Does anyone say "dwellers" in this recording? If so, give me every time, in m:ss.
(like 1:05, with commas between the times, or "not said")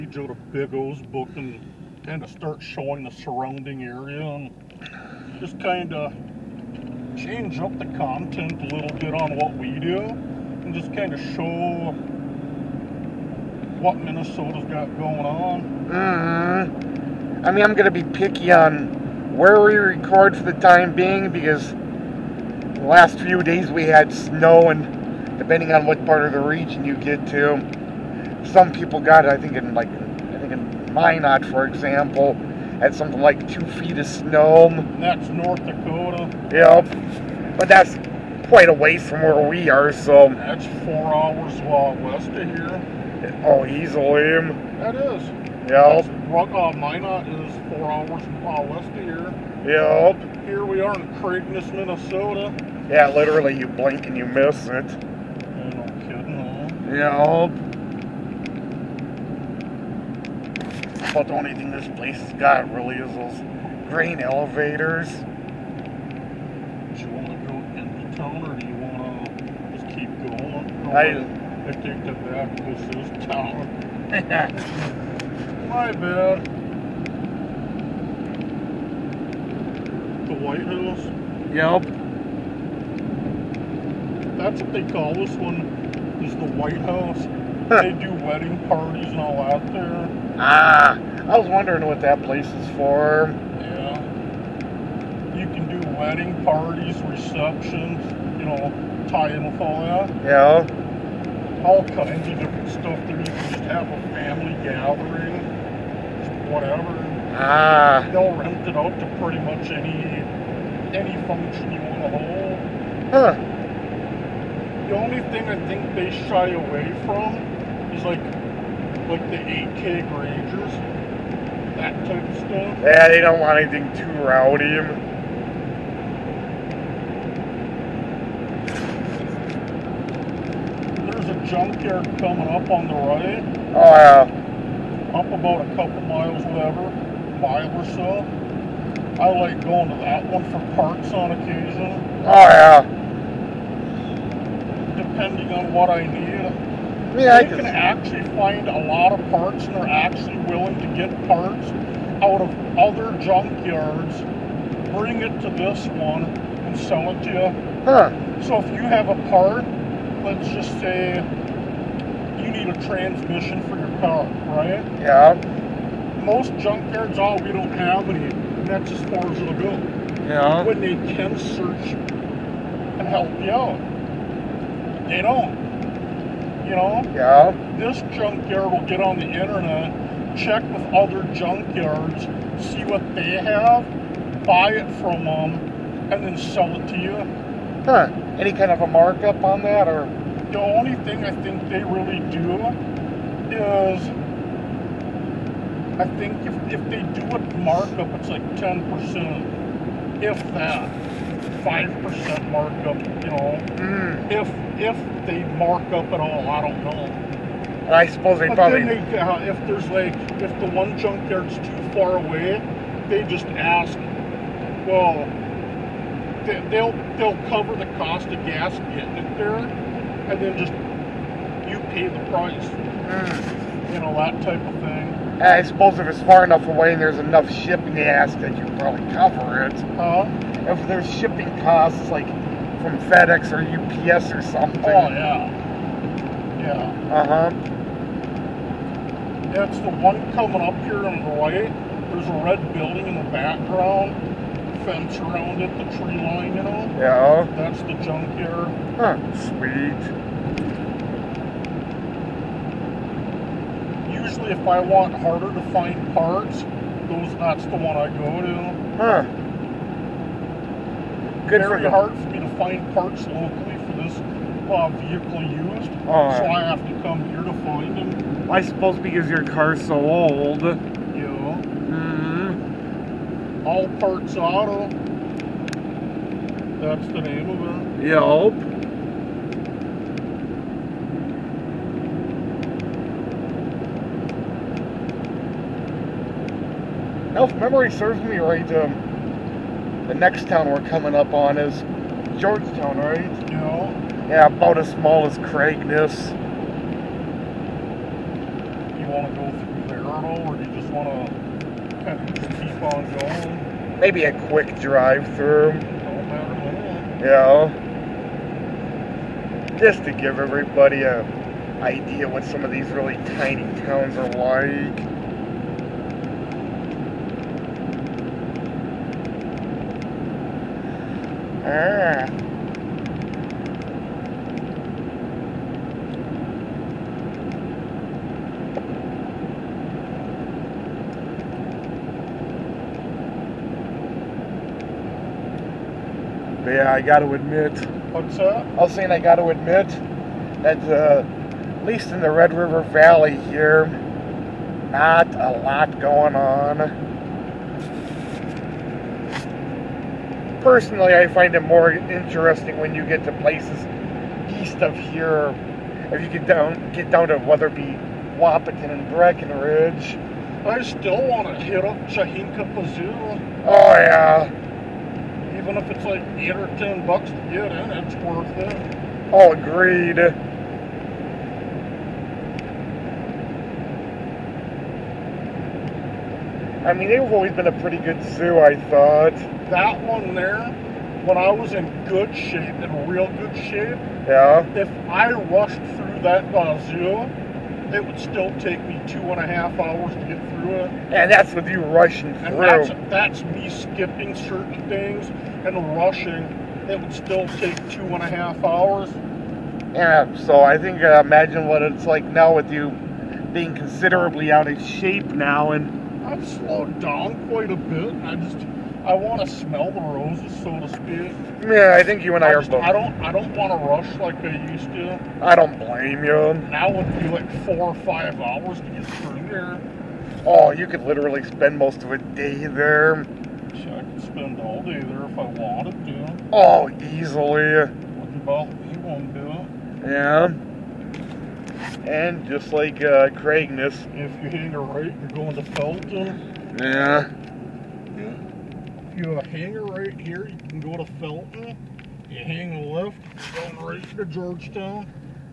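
not said.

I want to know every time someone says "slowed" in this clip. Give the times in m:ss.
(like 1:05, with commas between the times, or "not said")
6:46.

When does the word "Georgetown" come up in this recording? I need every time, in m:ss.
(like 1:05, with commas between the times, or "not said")
4:52, 7:24.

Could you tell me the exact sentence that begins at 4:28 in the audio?
I suppose because your car's so old.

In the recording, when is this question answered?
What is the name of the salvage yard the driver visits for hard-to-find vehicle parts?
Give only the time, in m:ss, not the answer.
4:33.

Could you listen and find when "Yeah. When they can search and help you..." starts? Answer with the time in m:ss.
2:50.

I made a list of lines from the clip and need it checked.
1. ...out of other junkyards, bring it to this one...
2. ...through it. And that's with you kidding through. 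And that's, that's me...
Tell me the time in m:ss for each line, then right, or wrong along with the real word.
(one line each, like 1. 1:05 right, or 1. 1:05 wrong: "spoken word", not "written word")
1. 2:32 right
2. 6:30 wrong: "rushing", not "kidding".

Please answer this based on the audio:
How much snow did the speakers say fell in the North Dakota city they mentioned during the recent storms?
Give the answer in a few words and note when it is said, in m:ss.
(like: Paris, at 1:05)
2 feet, at 0:33.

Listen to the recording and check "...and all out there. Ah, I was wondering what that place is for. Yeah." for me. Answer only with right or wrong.
right.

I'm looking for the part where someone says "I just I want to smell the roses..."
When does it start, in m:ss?
6:48.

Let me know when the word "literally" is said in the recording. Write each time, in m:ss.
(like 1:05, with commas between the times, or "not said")
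0:53, 7:01.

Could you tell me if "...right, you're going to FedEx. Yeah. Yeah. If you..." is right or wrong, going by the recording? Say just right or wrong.
wrong.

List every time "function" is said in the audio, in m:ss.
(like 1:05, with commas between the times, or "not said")
1:51.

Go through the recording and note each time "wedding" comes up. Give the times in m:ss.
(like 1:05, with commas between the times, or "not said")
1:28, 1:35.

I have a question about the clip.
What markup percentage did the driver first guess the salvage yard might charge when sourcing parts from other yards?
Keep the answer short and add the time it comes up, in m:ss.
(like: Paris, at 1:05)
10%, at 3:18.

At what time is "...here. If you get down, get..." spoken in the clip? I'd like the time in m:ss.
5:54.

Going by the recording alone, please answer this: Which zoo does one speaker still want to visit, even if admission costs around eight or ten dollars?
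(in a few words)
Chahinkapa Zoo.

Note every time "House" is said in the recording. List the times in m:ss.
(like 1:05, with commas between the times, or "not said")
1:20, 1:26.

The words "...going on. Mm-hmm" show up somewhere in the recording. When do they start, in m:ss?
0:14.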